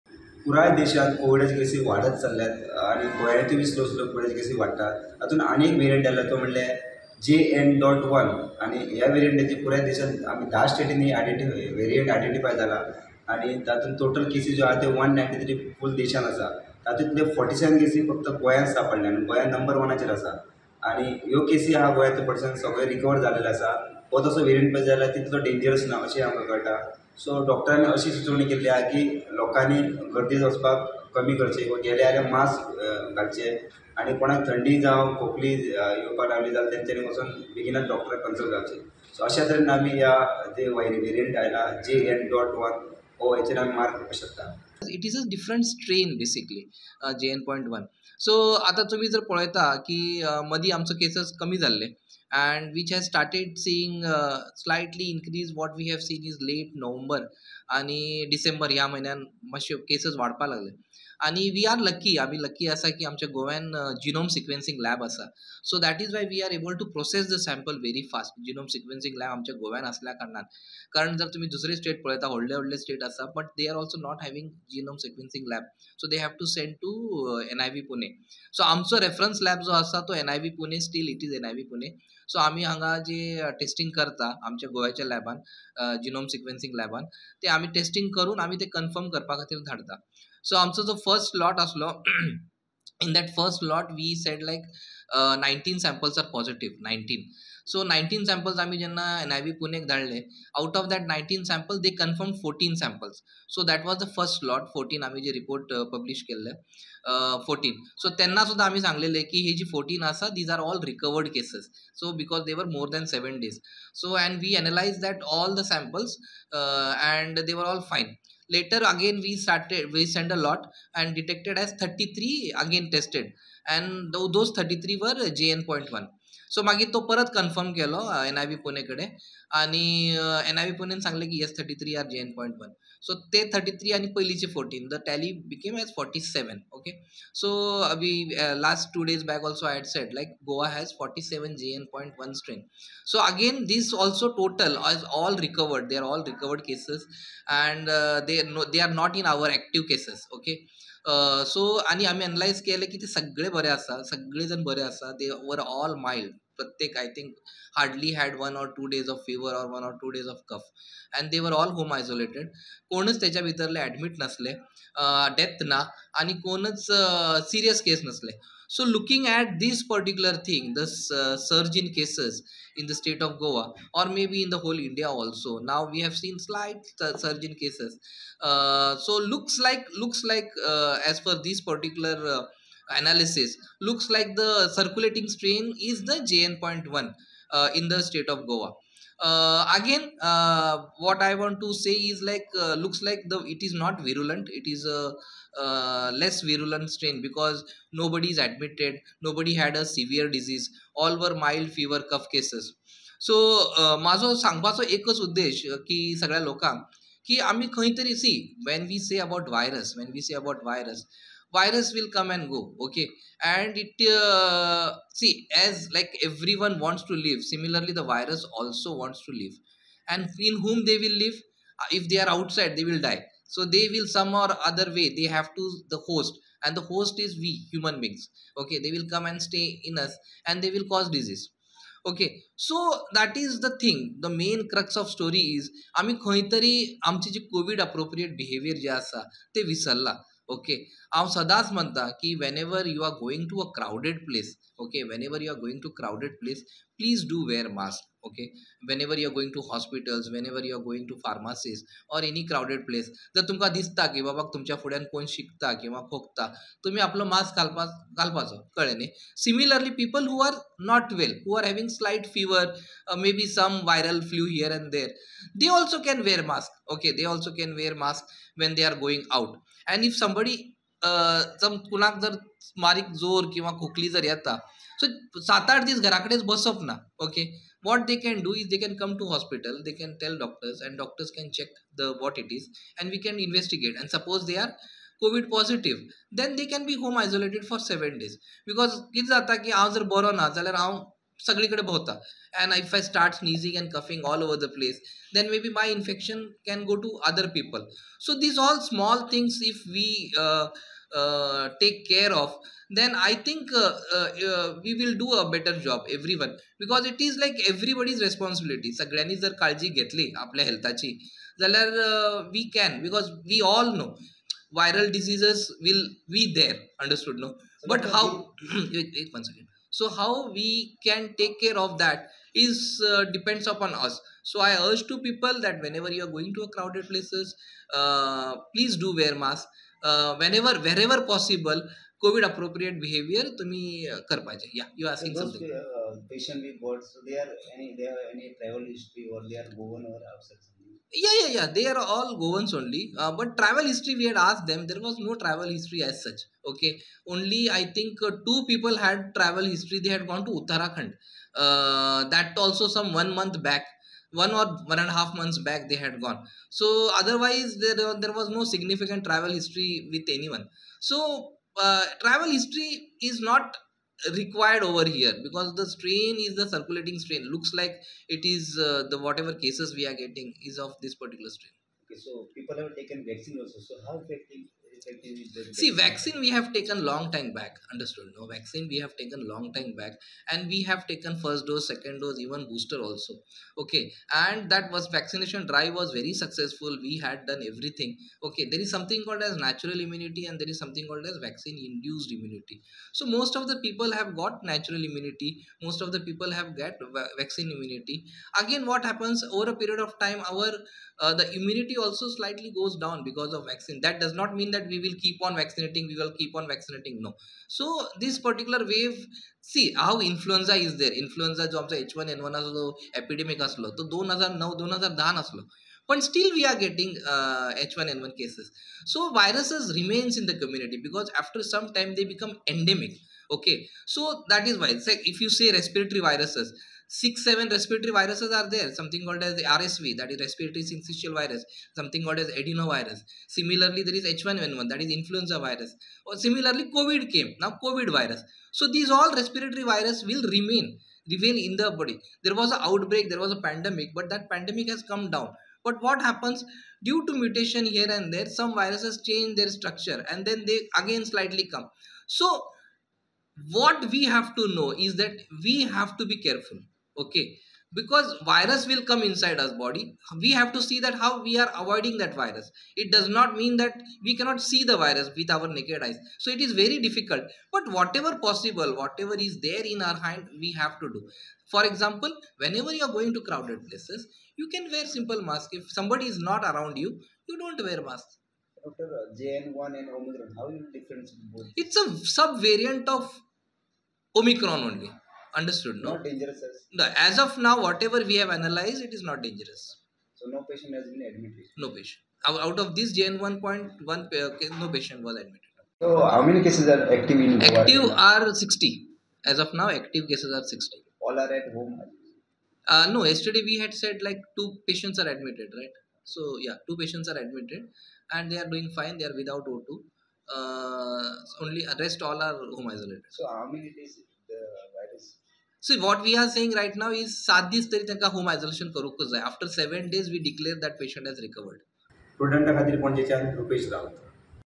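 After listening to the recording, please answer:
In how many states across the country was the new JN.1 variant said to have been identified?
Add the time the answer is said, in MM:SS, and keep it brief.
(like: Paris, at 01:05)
10, at 00:10.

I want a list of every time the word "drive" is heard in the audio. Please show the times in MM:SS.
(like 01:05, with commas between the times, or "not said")
06:25.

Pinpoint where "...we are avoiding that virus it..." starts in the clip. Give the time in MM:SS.
07:41.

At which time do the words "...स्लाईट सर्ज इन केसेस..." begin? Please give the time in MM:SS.
02:56.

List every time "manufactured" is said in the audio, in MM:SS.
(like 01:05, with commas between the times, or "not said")
not said.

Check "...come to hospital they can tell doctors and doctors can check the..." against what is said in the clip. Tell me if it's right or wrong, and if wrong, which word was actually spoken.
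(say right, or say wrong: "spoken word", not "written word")
right.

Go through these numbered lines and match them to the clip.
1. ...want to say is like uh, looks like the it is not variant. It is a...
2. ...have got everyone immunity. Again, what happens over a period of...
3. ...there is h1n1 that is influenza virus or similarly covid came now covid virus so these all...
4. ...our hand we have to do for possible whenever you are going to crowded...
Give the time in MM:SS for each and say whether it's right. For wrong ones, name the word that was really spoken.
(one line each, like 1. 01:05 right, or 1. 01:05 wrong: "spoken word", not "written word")
1. 03:11 wrong: "virulent", not "variant"
2. 06:36 wrong: "vaccine", not "everyone"
3. 07:14 right
4. 07:50 wrong: "example", not "possible".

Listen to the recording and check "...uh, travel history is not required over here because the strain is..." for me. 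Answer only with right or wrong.
right.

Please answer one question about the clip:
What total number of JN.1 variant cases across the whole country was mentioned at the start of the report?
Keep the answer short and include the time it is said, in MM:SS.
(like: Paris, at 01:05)
193, at 00:14.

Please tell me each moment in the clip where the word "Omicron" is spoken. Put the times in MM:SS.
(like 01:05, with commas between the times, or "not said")
08:00, 08:04.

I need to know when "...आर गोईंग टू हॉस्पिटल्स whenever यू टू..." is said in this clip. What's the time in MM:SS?
04:09.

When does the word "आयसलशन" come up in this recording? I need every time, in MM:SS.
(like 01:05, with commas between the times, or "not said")
08:38.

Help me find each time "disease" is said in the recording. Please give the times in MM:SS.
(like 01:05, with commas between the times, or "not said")
03:20, 03:51.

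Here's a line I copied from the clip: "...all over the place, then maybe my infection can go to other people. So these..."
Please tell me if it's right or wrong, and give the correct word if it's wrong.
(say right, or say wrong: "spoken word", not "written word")
right.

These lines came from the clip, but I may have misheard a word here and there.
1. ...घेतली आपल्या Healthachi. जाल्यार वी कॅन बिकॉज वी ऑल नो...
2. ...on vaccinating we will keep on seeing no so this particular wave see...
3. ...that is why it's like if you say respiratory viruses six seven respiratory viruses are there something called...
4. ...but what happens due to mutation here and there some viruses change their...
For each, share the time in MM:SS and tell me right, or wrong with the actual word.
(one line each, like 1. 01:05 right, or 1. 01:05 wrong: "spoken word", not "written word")
1. 05:09 right
2. 06:45 wrong: "vaccinating", not "seeing"
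3. 07:04 right
4. 07:25 right.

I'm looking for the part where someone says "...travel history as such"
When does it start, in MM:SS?
05:45.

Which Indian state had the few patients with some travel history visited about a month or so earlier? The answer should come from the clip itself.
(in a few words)
Uttarakhand.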